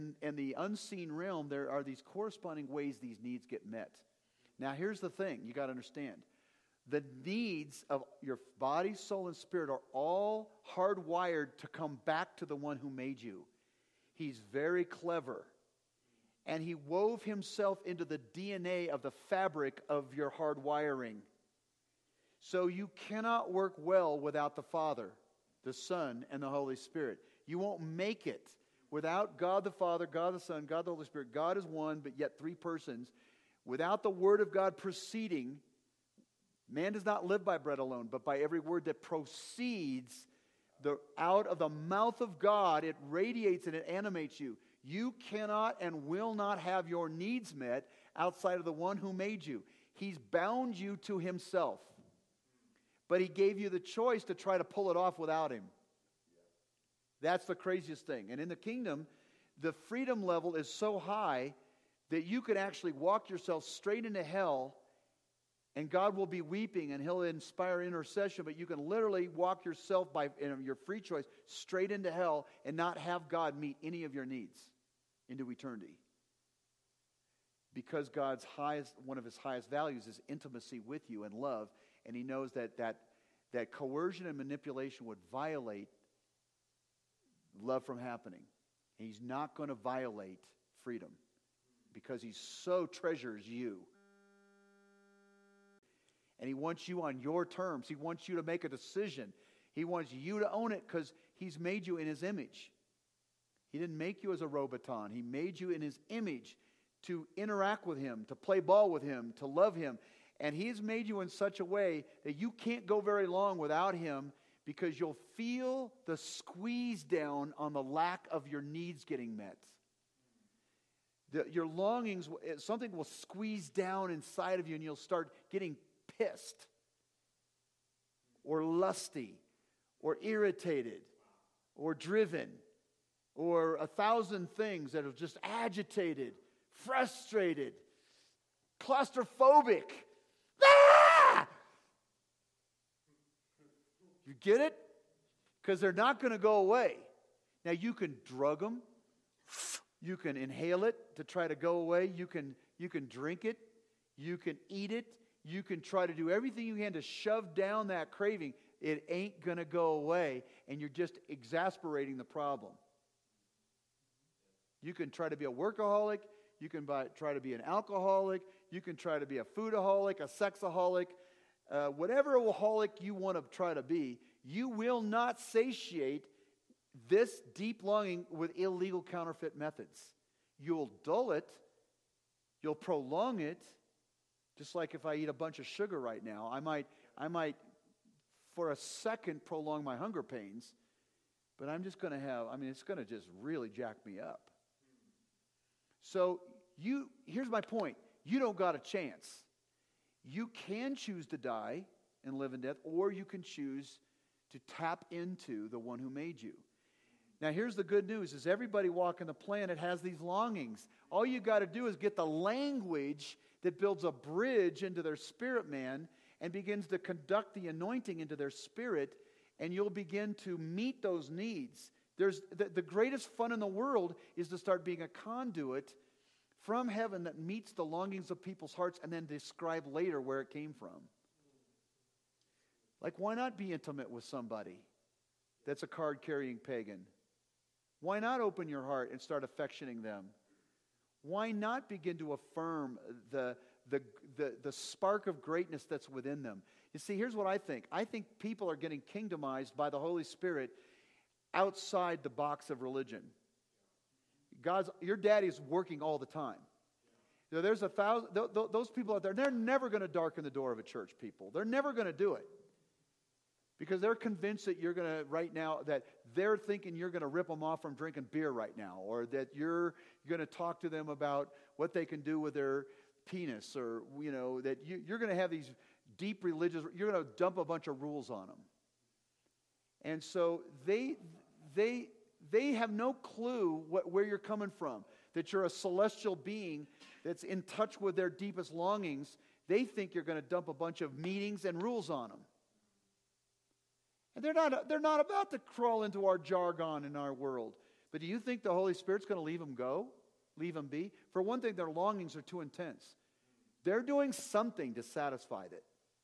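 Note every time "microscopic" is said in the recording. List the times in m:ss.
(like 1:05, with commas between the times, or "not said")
not said.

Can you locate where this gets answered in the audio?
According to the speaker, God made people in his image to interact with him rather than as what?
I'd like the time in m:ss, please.
1:44.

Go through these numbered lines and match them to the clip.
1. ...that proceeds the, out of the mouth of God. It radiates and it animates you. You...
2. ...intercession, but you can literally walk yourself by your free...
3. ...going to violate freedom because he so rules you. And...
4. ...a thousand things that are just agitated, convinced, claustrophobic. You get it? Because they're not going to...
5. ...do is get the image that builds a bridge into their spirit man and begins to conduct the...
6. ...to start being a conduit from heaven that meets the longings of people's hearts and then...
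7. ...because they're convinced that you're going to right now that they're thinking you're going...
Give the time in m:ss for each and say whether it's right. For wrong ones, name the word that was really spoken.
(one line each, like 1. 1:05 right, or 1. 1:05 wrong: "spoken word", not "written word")
1. 0:38 right
2. 1:07 right
3. 1:29 wrong: "treasures", not "rules"
4. 2:13 wrong: "frustrated", not "convinced"
5. 3:31 wrong: "language", not "image"
6. 3:44 right
7. 4:23 right.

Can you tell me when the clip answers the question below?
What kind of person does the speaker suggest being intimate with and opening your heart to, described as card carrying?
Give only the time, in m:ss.
3:56.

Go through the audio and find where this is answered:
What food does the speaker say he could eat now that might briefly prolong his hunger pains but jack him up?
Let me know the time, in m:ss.
3:05.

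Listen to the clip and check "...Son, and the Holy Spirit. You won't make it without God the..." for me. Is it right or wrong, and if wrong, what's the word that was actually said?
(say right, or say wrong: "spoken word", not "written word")
right.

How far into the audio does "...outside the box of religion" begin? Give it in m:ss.
4:11.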